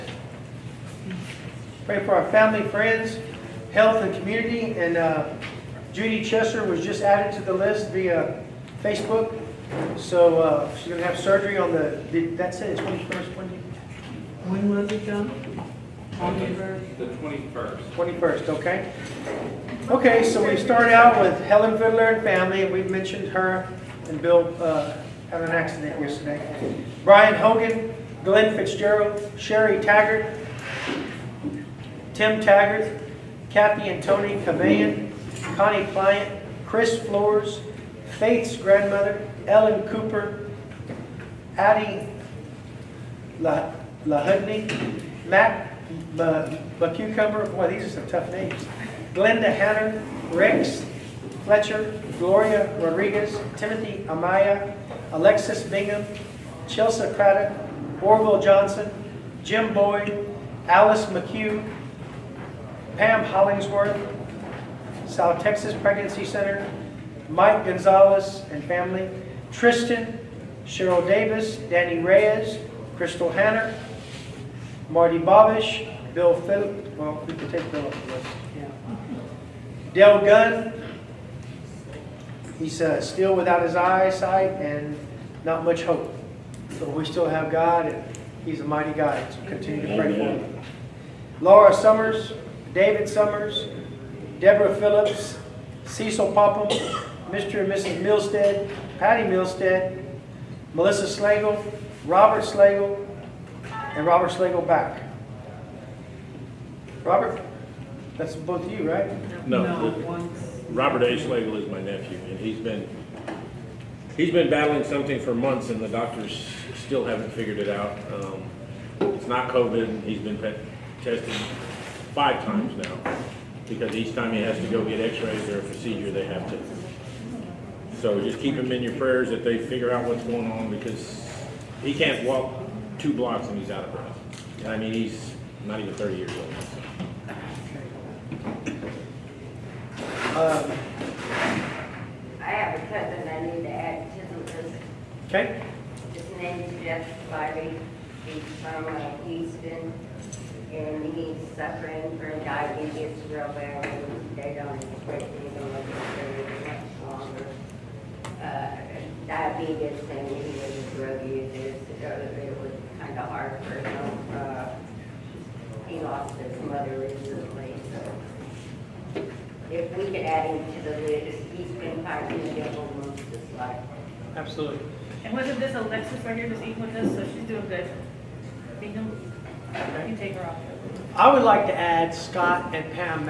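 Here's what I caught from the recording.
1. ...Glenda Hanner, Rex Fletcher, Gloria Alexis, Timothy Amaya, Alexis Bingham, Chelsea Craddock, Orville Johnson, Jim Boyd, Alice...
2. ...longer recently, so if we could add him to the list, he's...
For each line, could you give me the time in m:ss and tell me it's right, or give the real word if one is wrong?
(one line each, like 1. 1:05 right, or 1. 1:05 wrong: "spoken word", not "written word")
1. 0:49 wrong: "Rodriguez", not "Alexis"
2. 2:46 wrong: "mother", not "longer".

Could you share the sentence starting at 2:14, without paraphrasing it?
And I mean, he's not even 30 years old.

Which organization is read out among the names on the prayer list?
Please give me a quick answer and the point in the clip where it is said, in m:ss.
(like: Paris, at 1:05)
South Texas Pregnancy Center, at 1:05.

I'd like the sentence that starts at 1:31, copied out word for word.
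Laura Summers, David Summers, Deborah Phillips, Cecil Popham, Mr.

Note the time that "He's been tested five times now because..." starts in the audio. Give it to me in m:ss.
2:00.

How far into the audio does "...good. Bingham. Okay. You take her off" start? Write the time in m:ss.
2:57.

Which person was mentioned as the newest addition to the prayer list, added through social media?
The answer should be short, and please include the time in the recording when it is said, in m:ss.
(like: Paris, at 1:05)
Judy Chesser, at 0:05.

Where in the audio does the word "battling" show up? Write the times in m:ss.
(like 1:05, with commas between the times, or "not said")
1:54.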